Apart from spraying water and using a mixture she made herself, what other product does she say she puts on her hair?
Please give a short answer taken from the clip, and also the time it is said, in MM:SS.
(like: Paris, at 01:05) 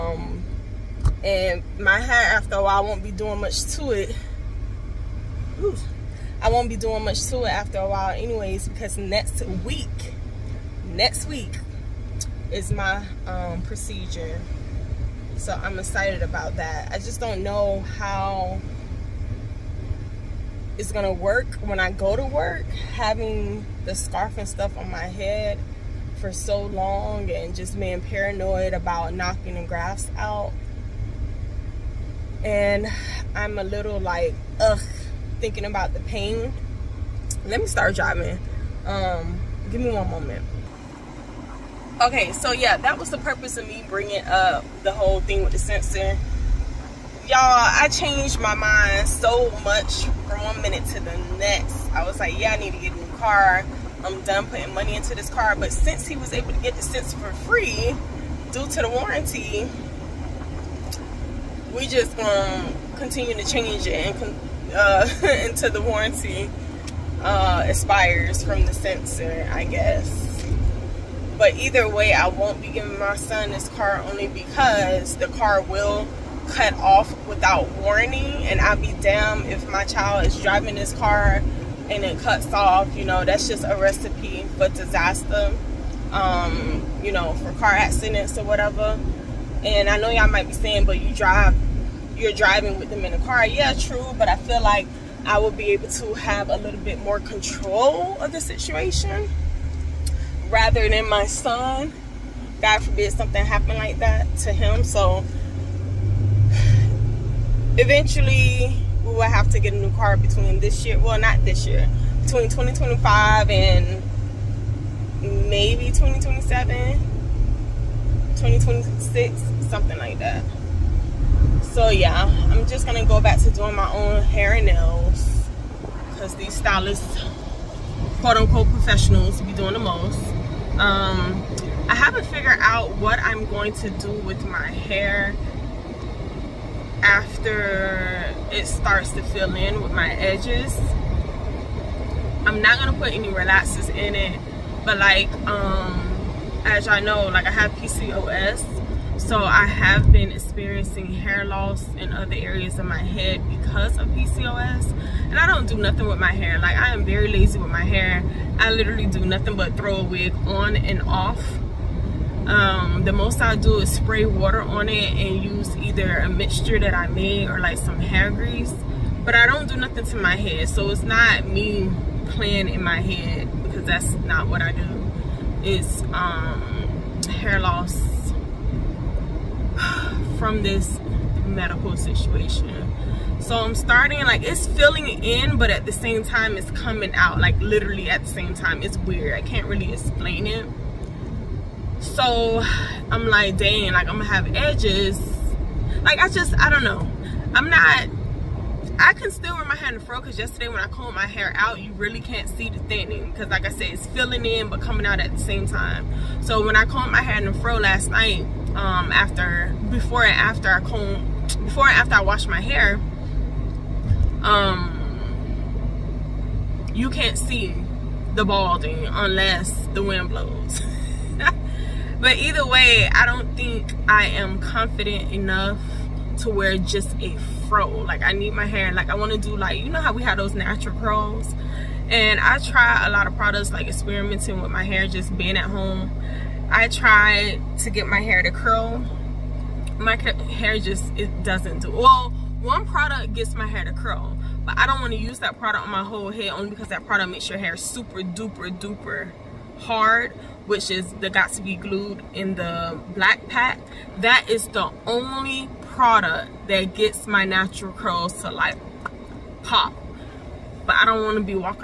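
hair grease, at 02:47.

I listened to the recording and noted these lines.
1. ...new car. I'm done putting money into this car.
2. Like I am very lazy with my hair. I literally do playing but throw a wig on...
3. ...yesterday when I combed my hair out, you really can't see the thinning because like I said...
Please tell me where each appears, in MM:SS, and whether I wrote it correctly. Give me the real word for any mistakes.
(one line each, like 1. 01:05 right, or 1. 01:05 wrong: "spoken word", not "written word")
1. 00:52 right
2. 02:36 wrong: "nothing", not "playing"
3. 03:20 right.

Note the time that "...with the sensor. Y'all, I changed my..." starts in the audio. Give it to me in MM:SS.
00:45.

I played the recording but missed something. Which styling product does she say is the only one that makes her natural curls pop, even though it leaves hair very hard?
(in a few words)
Got2b Glued.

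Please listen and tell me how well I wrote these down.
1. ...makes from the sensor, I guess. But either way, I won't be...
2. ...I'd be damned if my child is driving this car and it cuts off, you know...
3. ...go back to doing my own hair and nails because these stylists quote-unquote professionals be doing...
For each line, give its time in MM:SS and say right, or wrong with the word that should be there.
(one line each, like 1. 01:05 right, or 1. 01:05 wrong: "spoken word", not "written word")
1. 01:07 wrong: "expires", not "makes"
2. 01:18 right
3. 02:03 right.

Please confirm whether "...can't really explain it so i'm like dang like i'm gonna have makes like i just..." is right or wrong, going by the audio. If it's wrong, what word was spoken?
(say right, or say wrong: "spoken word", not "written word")
wrong: "edges", not "makes".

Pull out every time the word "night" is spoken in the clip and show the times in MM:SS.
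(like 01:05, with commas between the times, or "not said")
03:28.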